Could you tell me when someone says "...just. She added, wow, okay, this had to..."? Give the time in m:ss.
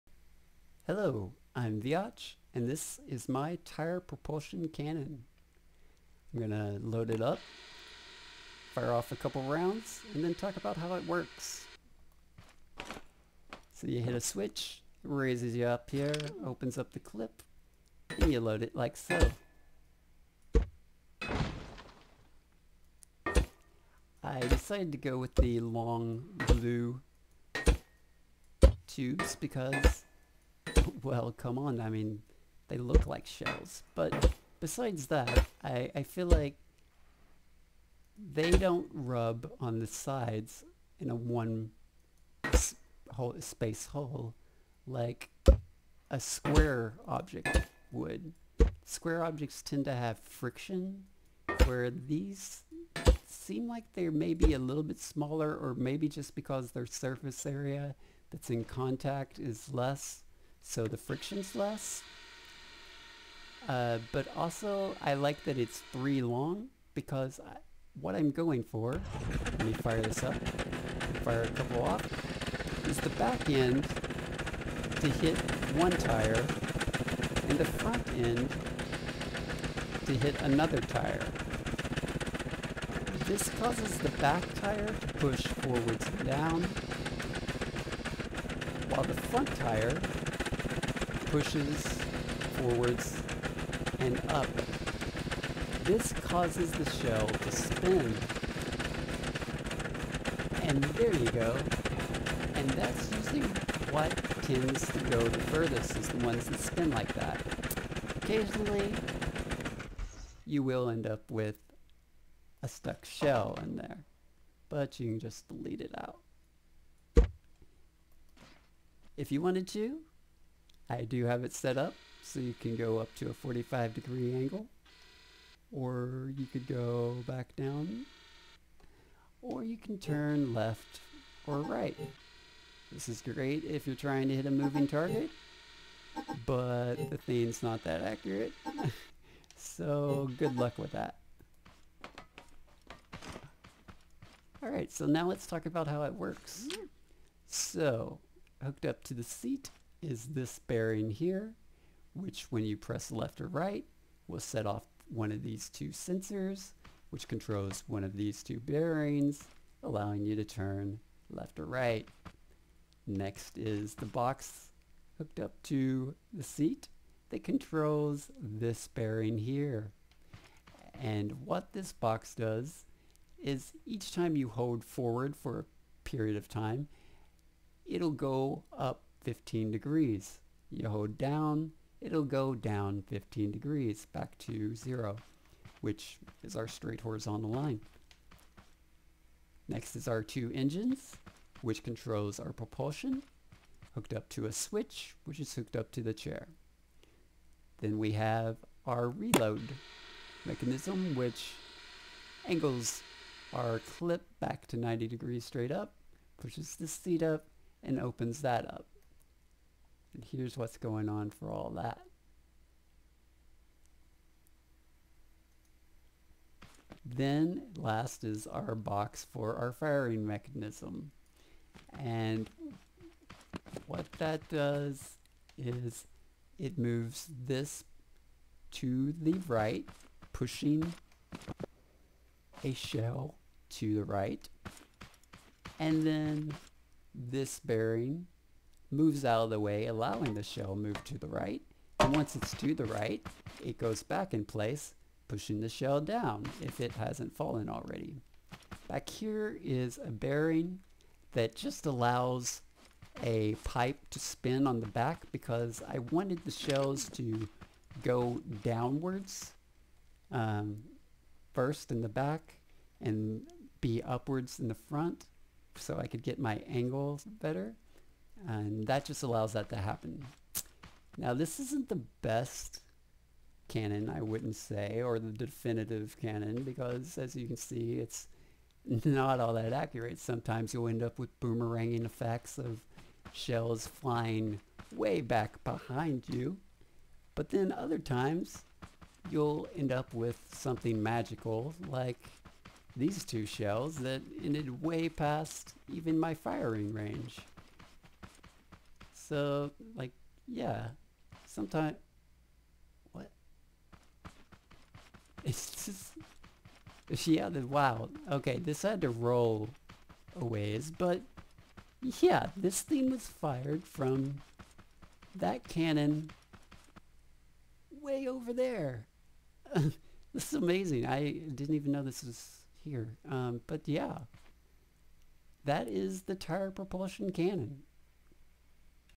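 5:05.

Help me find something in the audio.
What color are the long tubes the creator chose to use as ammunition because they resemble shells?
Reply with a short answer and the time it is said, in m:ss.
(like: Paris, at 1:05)
Blue, at 0:26.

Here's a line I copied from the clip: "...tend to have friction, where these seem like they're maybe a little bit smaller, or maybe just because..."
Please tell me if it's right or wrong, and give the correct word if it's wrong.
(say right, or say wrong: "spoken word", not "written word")
right.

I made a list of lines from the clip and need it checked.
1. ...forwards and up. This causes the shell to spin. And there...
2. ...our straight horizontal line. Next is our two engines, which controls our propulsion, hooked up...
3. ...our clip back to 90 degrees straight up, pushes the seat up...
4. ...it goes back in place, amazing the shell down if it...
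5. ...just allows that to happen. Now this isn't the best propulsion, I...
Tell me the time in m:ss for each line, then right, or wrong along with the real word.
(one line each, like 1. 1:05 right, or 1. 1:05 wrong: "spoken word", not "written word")
1. 1:32 right
2. 3:06 right
3. 3:23 right
4. 4:03 wrong: "pushing", not "amazing"
5. 4:29 wrong: "cannon", not "propulsion".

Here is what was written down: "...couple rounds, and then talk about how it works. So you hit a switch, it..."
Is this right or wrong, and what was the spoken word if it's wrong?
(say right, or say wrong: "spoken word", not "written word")
right.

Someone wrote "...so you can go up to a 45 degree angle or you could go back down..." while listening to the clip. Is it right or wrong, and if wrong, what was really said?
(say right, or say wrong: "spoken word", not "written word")
right.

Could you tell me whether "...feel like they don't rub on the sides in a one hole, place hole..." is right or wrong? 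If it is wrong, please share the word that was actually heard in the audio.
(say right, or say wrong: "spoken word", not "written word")
wrong: "space", not "place".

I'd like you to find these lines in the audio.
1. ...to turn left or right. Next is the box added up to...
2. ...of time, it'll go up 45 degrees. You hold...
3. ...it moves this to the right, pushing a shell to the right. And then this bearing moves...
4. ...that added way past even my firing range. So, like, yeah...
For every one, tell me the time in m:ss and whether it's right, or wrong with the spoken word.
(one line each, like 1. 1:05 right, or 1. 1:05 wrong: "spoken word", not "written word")
1. 2:40 wrong: "hooked", not "added"
2. 2:56 wrong: "15", not "45"
3. 3:46 right
4. 4:53 wrong: "ended", not "added".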